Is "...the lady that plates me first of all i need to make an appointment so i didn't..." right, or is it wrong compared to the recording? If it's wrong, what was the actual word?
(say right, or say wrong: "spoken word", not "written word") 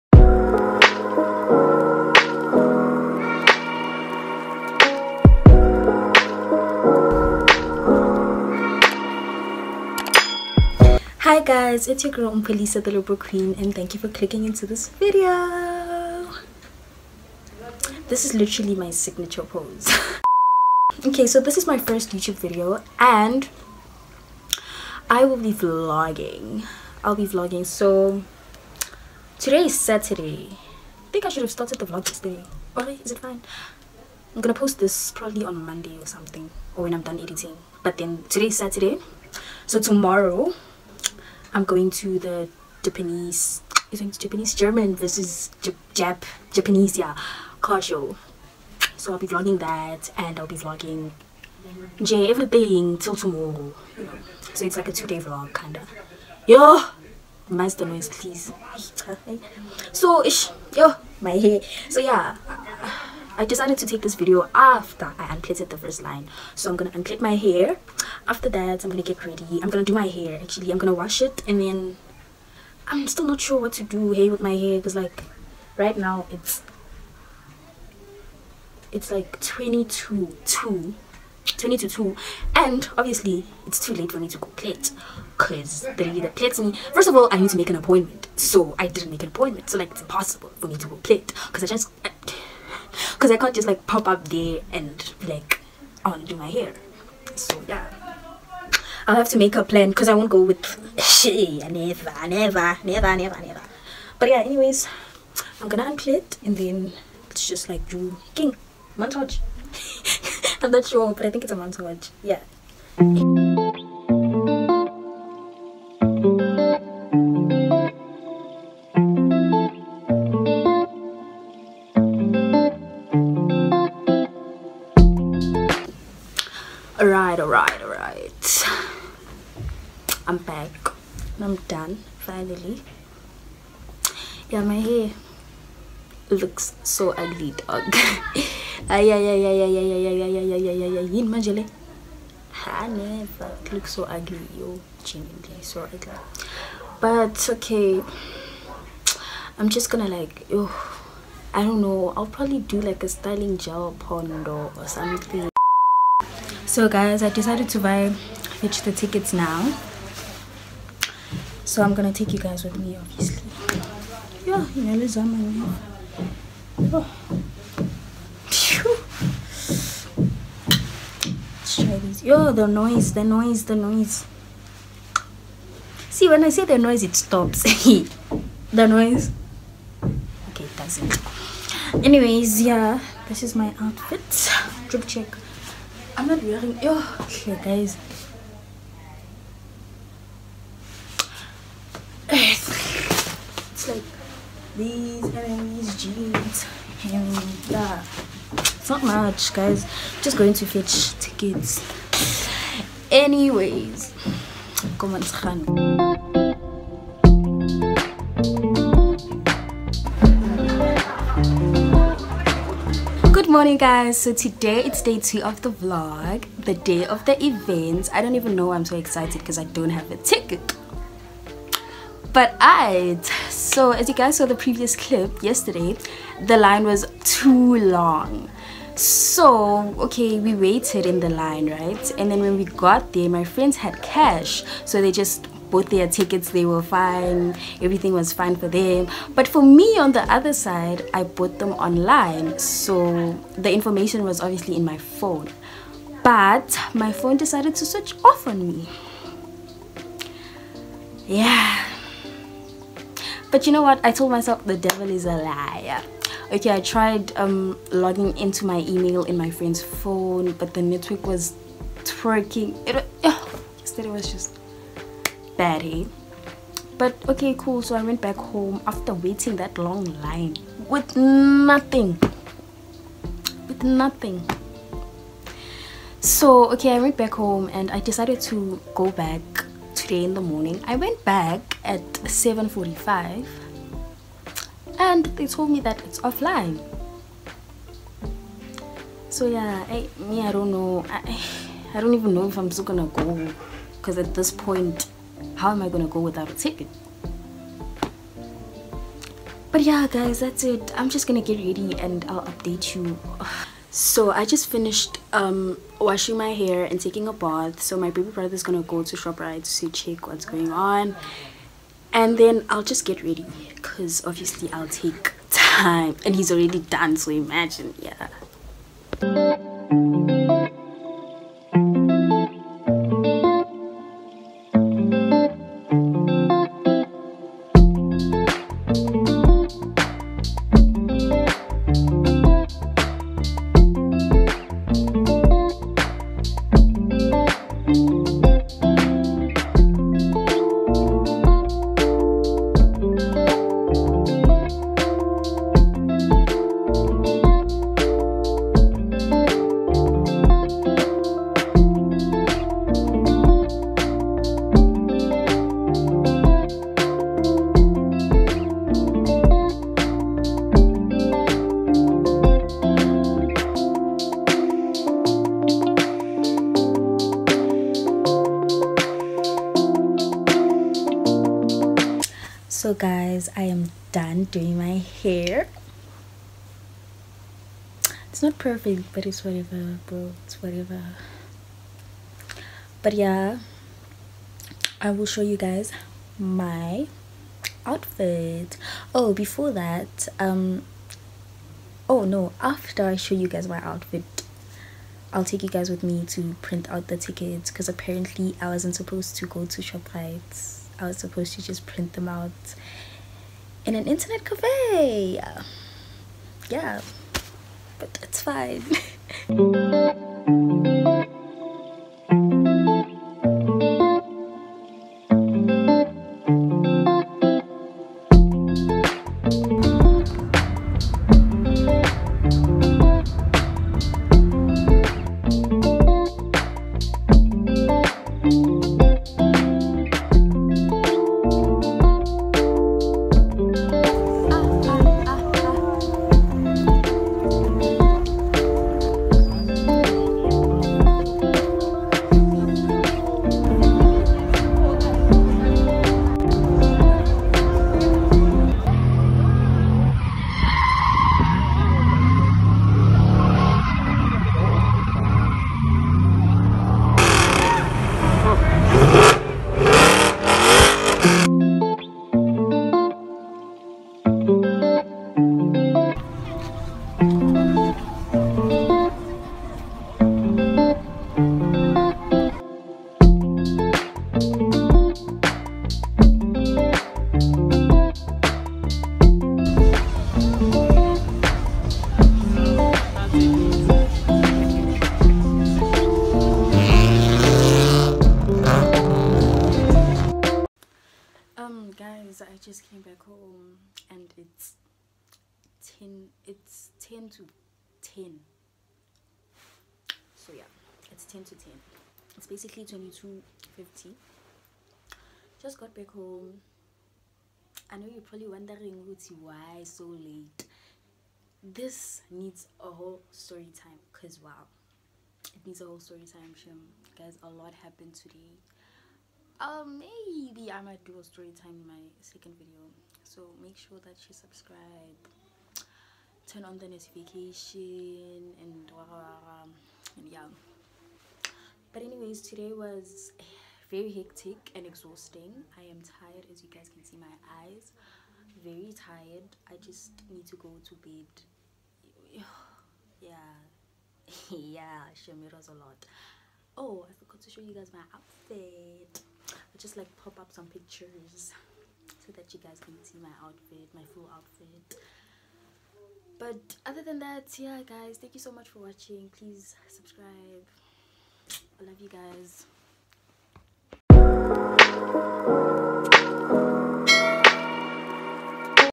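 right.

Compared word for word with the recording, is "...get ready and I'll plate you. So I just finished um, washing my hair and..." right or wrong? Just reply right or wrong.
wrong.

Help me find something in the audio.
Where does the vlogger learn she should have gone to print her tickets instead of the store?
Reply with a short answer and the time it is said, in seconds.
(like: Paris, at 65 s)
internet cafe, at 404 s.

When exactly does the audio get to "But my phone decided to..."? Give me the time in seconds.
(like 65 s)
246 s.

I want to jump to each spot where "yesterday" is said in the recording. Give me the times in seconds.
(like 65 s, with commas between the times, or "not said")
32 s, 225 s.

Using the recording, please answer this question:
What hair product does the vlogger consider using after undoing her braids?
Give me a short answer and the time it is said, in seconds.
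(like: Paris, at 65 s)
styling gel, at 153 s.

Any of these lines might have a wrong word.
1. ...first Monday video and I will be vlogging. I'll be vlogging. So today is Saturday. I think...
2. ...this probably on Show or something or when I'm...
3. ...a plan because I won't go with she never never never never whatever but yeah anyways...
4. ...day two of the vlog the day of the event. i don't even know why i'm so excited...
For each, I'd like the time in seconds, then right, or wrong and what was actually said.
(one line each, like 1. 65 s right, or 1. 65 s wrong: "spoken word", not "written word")
1. 21 s wrong: "YouTube", not "Monday"
2. 34 s wrong: "Monday", not "Show"
3. 99 s wrong: "never", not "whatever"
4. 215 s right.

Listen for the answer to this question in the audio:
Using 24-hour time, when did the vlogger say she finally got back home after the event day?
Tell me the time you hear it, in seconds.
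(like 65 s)
502 s.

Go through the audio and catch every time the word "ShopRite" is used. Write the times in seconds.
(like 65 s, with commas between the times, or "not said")
309 s, 399 s.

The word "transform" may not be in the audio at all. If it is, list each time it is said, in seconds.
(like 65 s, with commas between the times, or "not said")
not said.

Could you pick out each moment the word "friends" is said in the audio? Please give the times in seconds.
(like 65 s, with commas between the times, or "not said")
233 s, 259 s.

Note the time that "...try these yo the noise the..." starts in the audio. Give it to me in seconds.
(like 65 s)
171 s.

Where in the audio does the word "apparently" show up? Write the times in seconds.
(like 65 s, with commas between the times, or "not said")
397 s.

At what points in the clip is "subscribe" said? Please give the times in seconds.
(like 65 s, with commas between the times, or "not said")
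524 s, 559 s.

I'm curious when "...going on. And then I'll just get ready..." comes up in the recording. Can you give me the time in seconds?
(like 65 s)
310 s.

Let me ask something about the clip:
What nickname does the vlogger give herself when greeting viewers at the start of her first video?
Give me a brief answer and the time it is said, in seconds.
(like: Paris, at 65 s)
Umpelisa the Liberal Queen, at 12 s.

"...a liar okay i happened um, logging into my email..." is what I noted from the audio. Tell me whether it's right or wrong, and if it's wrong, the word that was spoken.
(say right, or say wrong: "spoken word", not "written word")
wrong: "tried", not "happened".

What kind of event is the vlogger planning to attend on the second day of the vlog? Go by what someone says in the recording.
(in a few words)
car show.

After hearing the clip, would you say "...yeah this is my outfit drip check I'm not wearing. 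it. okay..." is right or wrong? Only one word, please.
right.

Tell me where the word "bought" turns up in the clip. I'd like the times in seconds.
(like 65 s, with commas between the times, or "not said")
235 s, 241 s.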